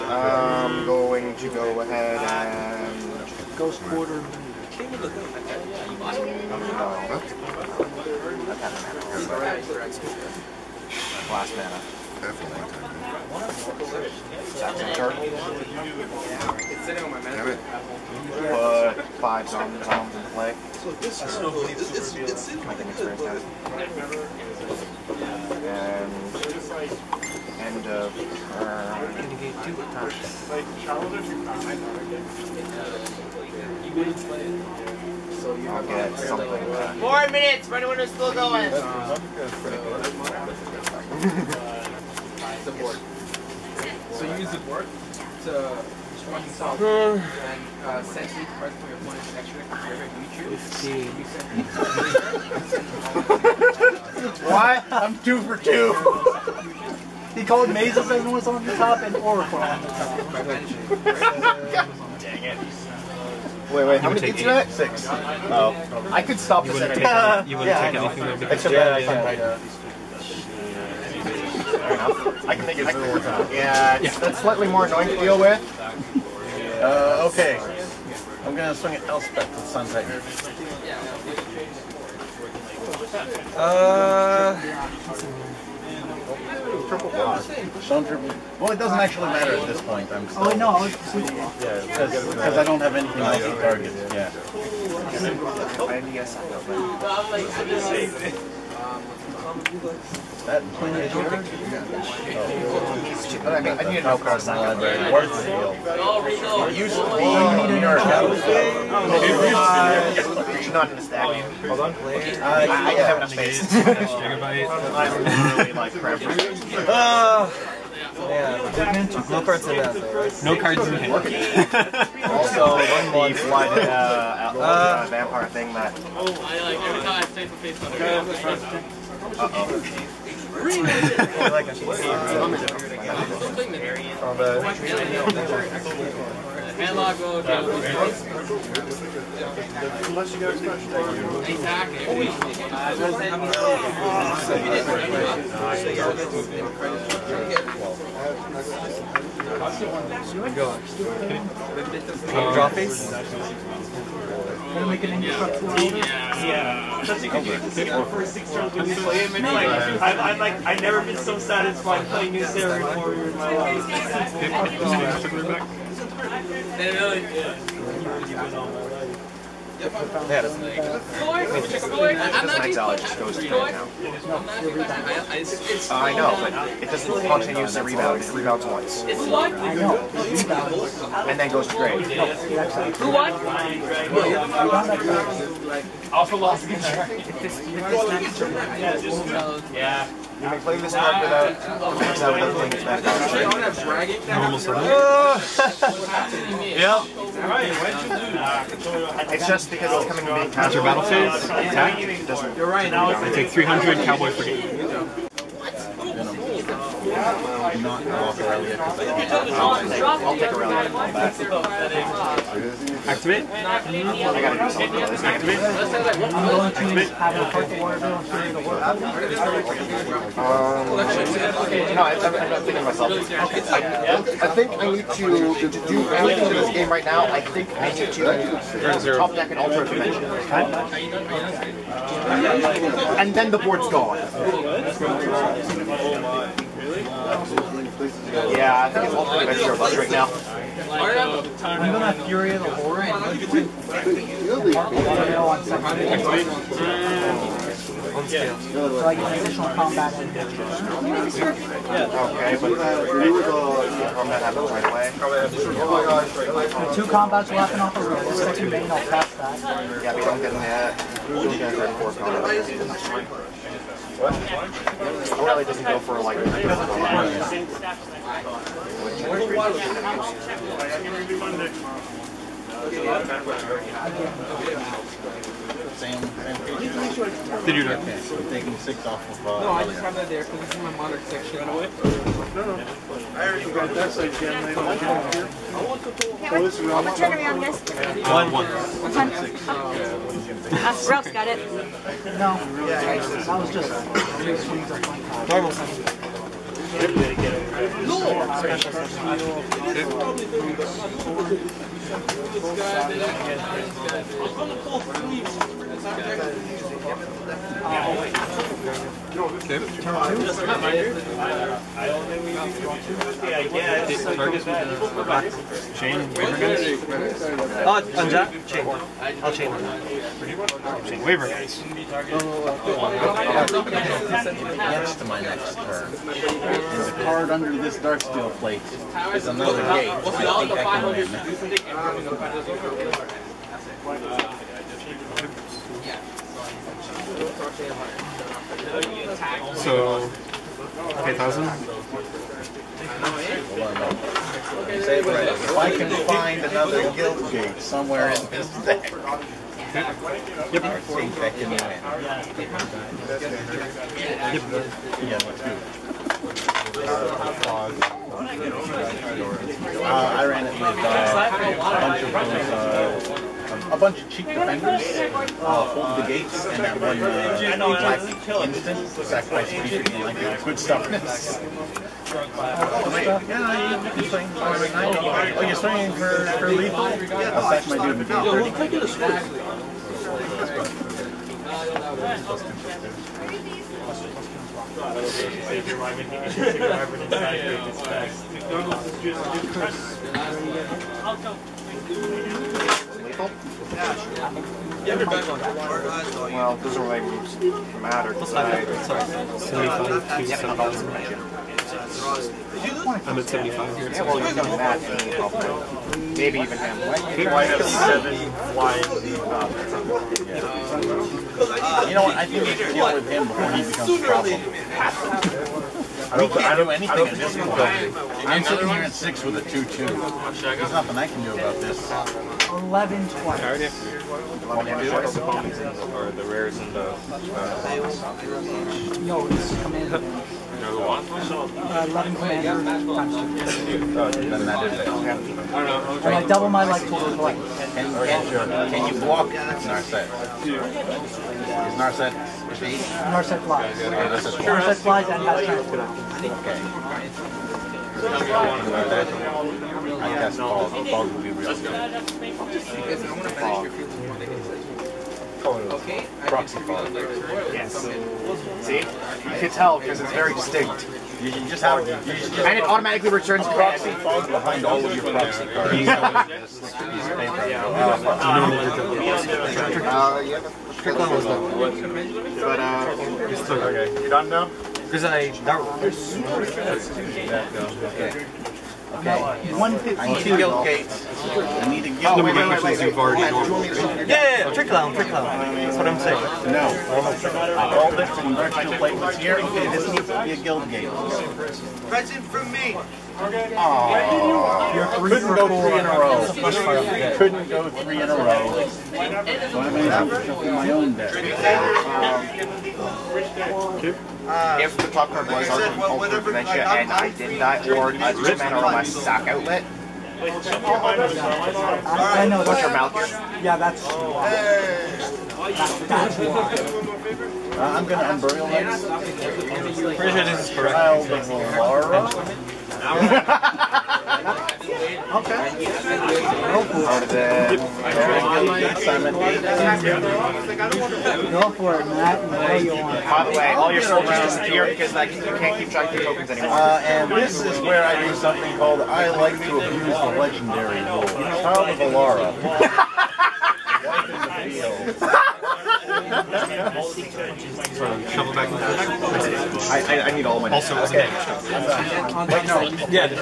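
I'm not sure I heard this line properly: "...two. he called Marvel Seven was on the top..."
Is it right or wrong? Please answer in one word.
wrong.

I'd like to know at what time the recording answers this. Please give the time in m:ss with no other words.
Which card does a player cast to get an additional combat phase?
4:02.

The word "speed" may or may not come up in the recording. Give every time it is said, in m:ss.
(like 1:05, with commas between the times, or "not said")
7:22.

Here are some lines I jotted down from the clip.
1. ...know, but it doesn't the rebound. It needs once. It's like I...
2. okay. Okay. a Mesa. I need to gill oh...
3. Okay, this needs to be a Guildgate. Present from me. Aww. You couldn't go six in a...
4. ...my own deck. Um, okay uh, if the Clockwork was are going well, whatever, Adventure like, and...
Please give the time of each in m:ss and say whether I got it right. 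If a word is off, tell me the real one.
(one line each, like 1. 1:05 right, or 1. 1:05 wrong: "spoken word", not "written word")
1. 2:56 wrong: "rebounds", not "needs"
2. 7:58 wrong: "Guildgate", not "Mesa"
3. 8:09 wrong: "three", not "six"
4. 8:20 right.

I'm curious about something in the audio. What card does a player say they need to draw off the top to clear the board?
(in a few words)
Ultra Dimension.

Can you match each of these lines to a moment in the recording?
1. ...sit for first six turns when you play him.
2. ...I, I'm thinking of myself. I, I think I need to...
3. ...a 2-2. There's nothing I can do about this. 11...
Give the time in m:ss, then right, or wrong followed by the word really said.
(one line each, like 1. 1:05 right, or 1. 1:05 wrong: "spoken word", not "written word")
1. 2:37 right
2. 3:42 right
3. 6:59 right.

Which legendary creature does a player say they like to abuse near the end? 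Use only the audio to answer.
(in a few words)
Child of Alara.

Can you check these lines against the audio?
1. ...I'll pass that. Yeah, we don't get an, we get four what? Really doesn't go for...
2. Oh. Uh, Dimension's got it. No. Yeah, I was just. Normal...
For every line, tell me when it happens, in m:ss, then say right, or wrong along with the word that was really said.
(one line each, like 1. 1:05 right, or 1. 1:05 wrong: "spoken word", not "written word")
1. 4:18 right
2. 4:49 wrong: "Ralph", not "Dimension".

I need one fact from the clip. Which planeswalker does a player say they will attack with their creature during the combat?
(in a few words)
Elspeth.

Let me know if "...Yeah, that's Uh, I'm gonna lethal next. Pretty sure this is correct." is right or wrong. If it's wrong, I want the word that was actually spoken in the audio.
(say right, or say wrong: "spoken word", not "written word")
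wrong: "unburial", not "lethal".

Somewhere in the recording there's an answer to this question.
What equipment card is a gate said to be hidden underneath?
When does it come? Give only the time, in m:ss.
5:27.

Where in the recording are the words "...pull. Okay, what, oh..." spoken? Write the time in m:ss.
4:46.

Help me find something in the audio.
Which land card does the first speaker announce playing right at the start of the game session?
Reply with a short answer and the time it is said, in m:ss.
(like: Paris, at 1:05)
Ghost Quarter, at 0:03.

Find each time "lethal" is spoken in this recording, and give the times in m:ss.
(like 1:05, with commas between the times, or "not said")
6:16.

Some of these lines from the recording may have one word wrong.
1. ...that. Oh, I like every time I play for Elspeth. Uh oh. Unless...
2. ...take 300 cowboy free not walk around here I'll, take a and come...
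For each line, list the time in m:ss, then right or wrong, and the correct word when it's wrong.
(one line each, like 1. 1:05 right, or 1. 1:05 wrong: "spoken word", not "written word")
1. 2:05 wrong: "Facebook", not "Elspeth"
2. 3:23 right.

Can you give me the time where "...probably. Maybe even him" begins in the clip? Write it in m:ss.
6:45.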